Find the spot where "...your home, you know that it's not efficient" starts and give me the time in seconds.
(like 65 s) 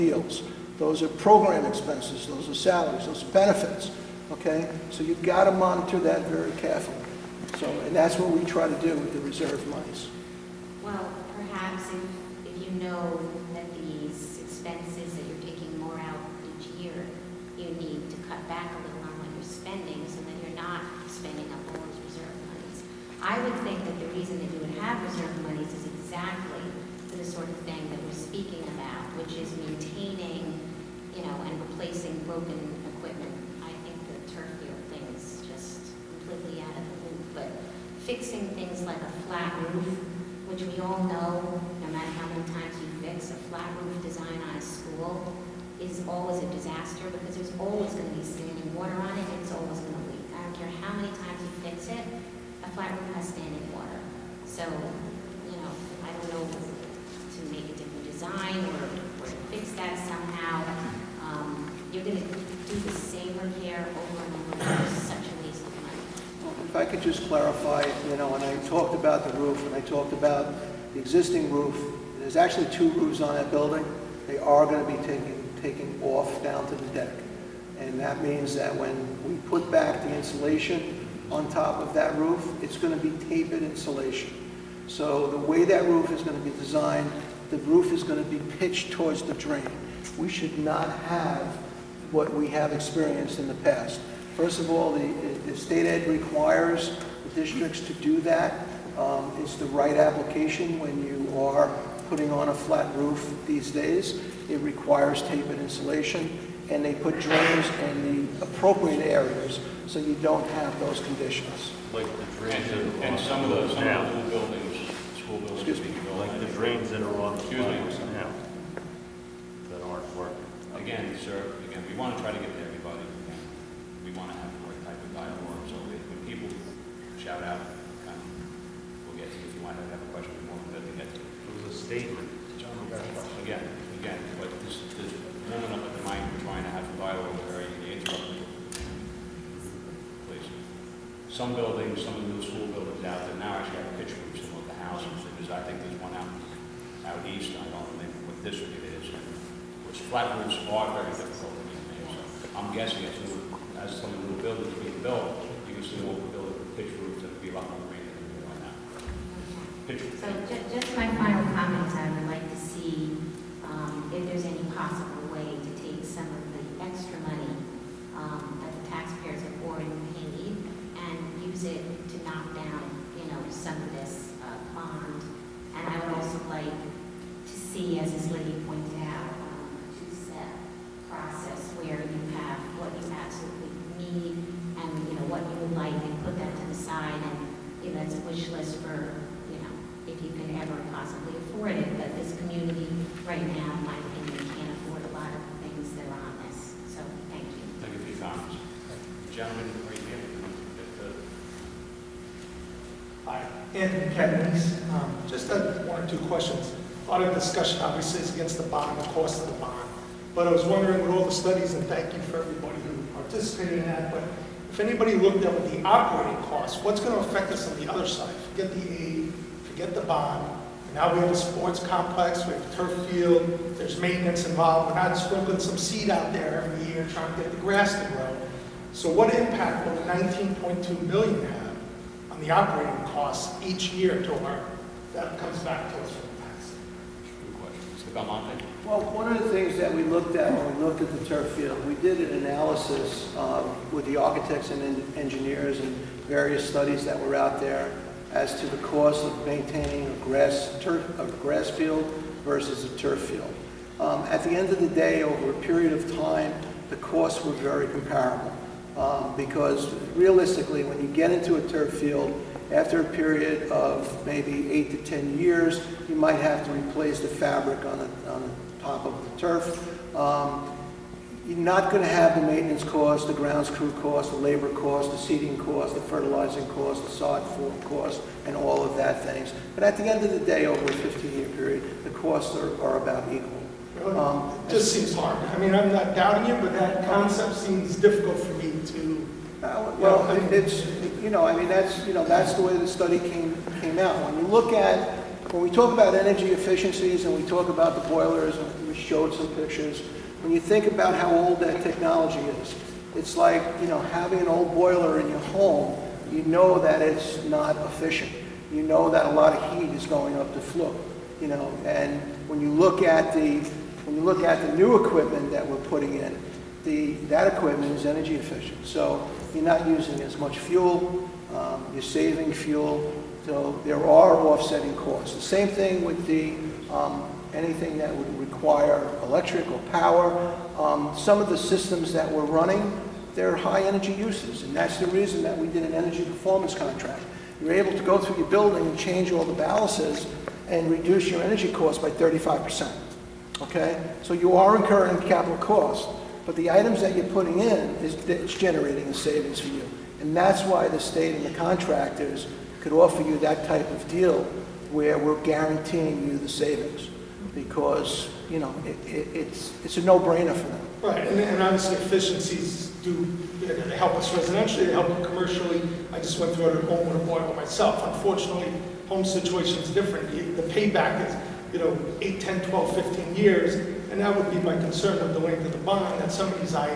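305 s.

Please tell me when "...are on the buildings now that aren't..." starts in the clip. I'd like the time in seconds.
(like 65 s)
117 s.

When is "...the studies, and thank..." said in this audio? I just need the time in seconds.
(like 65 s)
211 s.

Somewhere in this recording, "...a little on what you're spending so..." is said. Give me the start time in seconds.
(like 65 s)
18 s.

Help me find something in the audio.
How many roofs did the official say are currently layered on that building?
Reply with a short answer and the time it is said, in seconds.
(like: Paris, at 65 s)
2, at 72 s.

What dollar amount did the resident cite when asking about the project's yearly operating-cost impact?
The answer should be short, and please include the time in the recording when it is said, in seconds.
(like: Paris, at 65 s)
19.2 million, at 230 s.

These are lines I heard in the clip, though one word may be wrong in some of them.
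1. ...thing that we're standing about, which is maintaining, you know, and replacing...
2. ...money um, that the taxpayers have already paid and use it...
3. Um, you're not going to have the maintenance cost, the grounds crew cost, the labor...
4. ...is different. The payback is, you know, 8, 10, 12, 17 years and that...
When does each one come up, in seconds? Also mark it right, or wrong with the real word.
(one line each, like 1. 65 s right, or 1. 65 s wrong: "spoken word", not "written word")
1. 27 s wrong: "speaking", not "standing"
2. 167 s right
3. 270 s right
4. 369 s wrong: "15", not "17".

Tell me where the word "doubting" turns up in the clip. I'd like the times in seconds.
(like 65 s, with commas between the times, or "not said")
286 s.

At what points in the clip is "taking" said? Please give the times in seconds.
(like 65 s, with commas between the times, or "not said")
15 s, 75 s.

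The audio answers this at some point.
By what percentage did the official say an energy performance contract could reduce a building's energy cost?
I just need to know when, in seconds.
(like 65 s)
342 s.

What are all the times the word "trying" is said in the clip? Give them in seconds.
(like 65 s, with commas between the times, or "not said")
136 s, 227 s.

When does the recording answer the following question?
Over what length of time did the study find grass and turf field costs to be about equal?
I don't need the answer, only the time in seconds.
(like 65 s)
280 s.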